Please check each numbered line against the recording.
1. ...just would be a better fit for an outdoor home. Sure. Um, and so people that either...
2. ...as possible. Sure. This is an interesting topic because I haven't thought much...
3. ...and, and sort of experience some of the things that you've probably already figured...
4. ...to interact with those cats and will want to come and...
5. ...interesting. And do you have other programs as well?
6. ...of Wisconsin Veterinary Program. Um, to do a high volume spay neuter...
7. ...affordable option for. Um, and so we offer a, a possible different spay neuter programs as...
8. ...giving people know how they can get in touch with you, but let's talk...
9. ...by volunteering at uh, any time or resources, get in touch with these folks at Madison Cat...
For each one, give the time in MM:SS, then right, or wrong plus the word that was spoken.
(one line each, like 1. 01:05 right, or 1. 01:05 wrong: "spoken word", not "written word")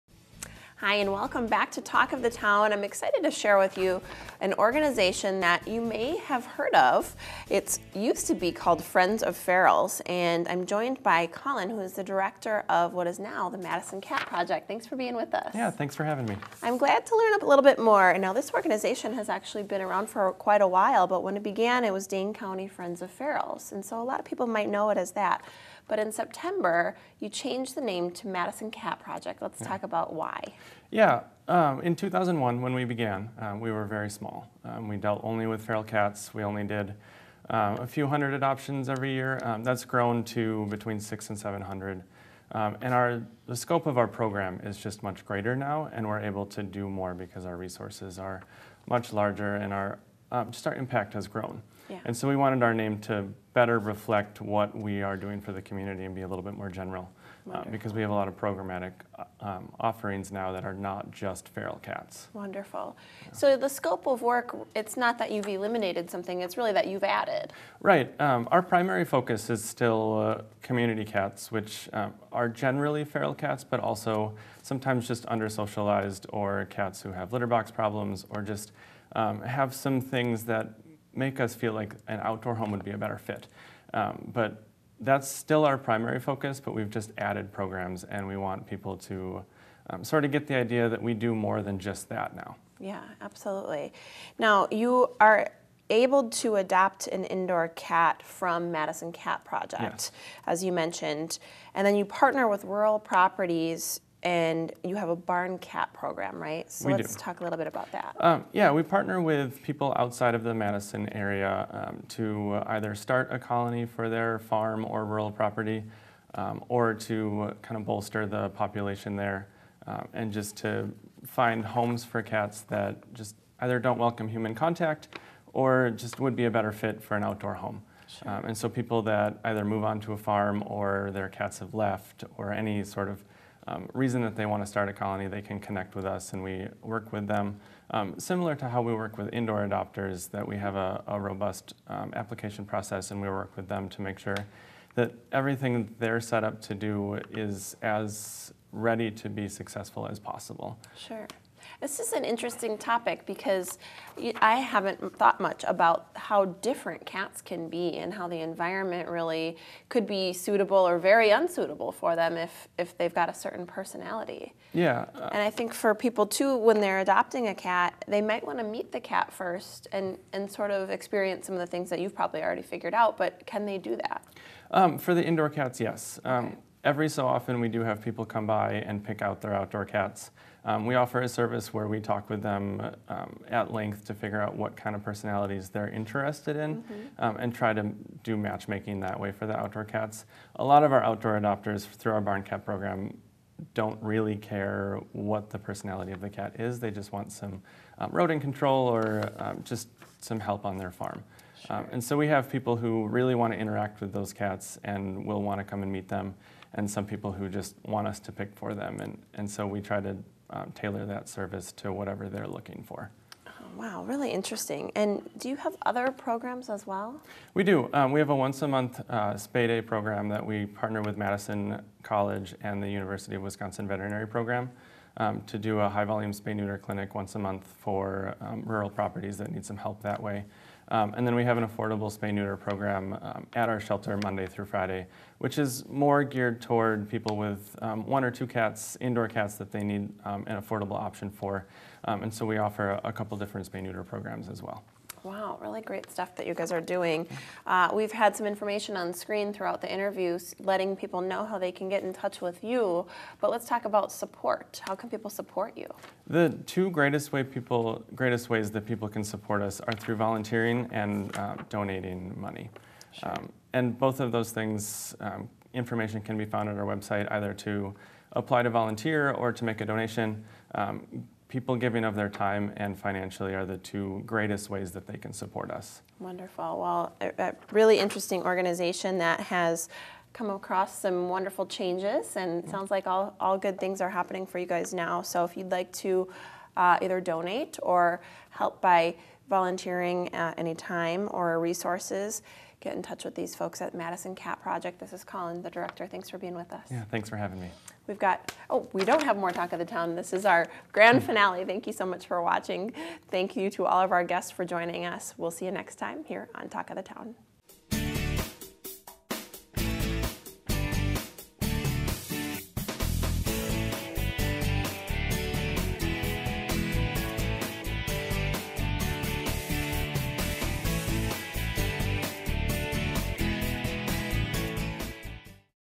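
1. 02:05 right
2. 02:30 right
3. 02:49 right
4. 03:23 right
5. 03:34 right
6. 03:43 right
7. 04:00 wrong: "couple", not "possible"
8. 04:10 wrong: "letting", not "giving"
9. 04:48 right.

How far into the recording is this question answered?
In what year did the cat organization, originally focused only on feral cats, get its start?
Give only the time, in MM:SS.
00:31.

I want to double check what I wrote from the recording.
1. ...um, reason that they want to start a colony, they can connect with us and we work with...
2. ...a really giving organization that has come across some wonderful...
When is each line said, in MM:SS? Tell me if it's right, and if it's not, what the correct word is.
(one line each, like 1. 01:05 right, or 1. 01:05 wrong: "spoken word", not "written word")
1. 02:13 right
2. 04:37 wrong: "interesting", not "giving".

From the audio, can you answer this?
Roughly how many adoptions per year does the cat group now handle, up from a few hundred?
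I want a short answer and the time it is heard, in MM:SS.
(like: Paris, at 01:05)
600 to 700, at 00:40.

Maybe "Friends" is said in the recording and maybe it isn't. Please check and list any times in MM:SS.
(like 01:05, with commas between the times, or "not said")
00:08, 00:22.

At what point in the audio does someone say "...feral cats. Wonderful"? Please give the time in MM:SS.
01:01.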